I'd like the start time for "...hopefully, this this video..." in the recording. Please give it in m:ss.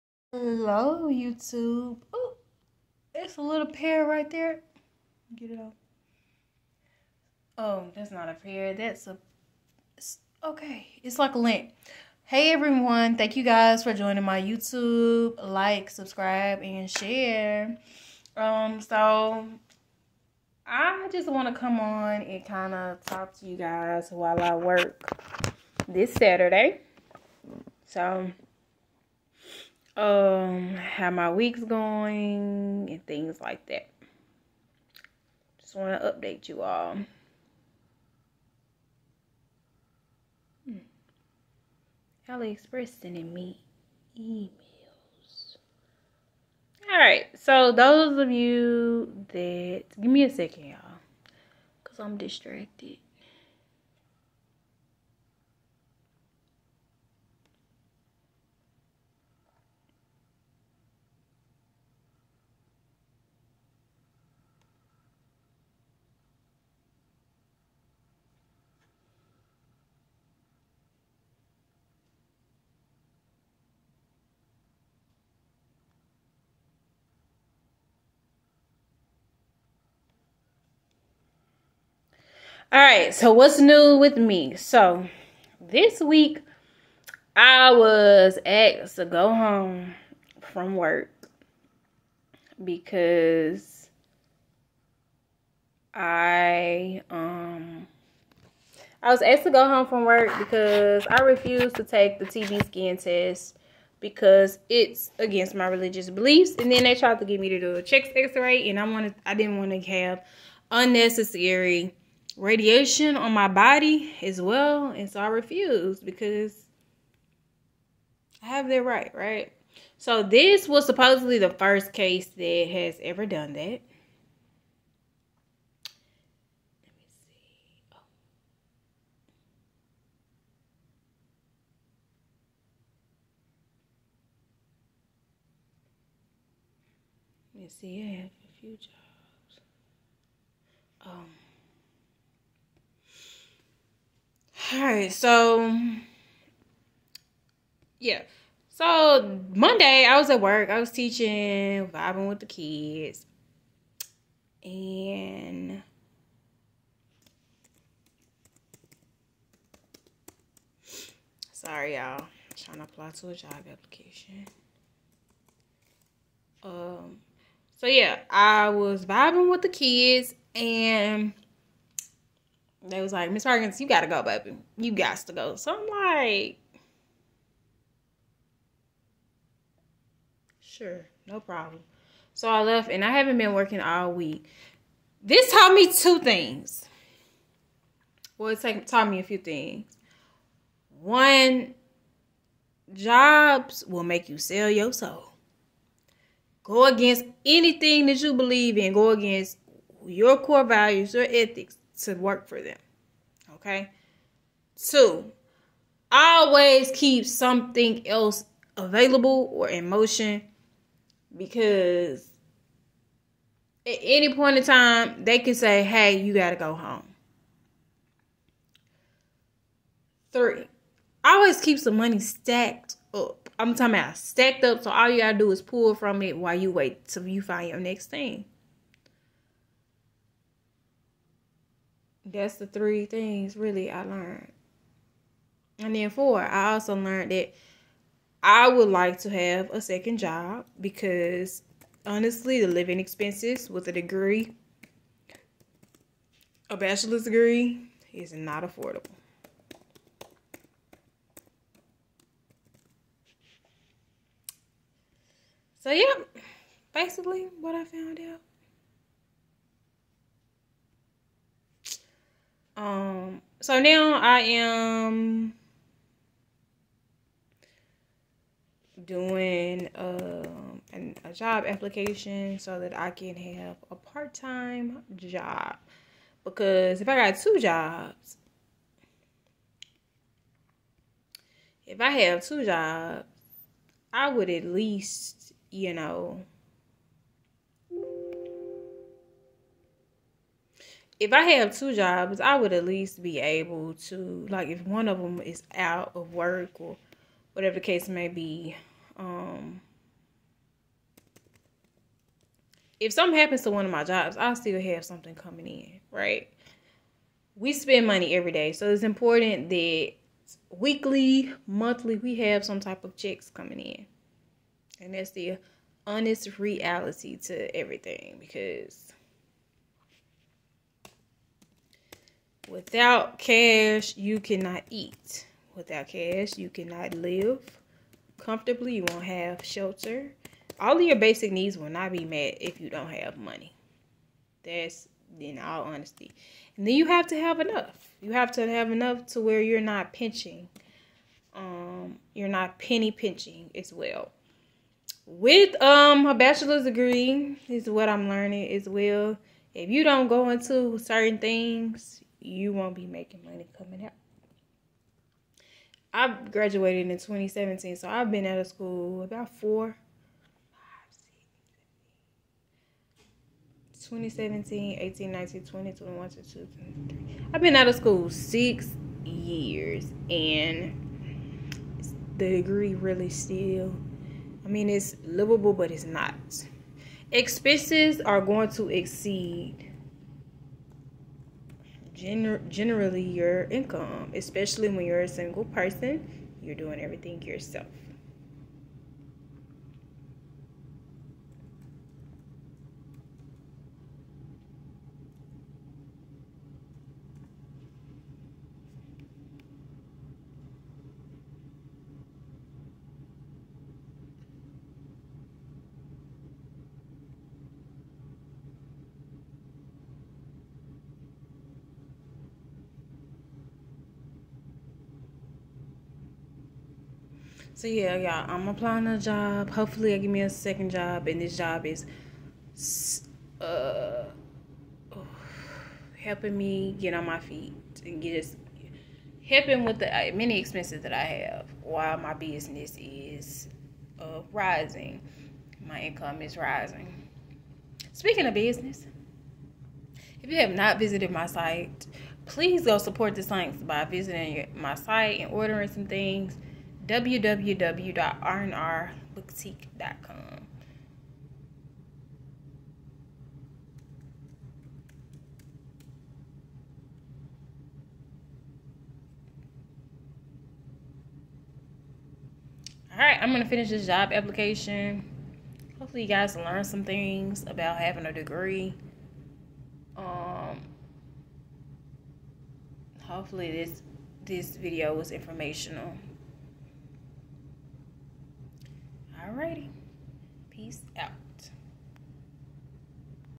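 7:53.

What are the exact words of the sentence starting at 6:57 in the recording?
So yeah, y'all, I'm applying a job.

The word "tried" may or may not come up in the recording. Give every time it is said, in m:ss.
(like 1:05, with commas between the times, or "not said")
1:46.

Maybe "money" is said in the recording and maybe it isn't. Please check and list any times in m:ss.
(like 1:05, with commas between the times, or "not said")
3:41, 5:08, 5:33, 5:53.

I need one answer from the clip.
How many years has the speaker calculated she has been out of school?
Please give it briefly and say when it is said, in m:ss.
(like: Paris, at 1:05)
6, at 6:08.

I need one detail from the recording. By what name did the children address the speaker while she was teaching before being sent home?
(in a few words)
Miss Perkins.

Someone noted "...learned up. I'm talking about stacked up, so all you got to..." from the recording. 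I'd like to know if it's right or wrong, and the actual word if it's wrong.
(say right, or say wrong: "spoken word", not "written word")
wrong: "stacked", not "learned".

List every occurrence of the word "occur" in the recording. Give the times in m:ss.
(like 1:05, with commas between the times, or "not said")
not said.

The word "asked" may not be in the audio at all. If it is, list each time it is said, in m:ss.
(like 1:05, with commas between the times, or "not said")
1:28, 1:39.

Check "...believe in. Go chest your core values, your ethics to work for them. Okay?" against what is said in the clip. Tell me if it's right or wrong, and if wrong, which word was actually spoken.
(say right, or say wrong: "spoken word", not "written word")
wrong: "against", not "chest".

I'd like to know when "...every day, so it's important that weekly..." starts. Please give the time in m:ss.
5:08.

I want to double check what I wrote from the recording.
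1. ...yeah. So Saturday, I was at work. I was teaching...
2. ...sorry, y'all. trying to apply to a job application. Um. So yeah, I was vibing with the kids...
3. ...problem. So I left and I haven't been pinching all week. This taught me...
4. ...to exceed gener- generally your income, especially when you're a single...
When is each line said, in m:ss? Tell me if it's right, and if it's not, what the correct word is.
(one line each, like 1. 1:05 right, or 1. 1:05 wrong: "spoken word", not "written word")
1. 2:27 wrong: "Monday", not "Saturday"
2. 2:41 right
3. 3:01 wrong: "working", not "pinching"
4. 6:18 right.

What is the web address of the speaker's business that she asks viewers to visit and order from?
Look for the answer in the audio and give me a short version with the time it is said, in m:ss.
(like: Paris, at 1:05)
www.rnrbooktique.com, at 7:27.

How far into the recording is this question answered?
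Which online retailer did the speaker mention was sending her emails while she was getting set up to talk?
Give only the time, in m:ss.
0:42.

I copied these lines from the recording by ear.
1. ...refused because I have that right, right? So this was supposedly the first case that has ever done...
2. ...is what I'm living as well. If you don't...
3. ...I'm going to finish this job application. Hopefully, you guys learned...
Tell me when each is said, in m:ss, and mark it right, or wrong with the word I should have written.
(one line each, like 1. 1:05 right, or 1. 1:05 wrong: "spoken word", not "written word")
1. 1:55 right
2. 5:47 wrong: "learning", not "living"
3. 7:43 right.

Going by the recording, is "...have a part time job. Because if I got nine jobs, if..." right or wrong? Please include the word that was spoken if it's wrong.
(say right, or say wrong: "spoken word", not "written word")
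wrong: "two", not "nine".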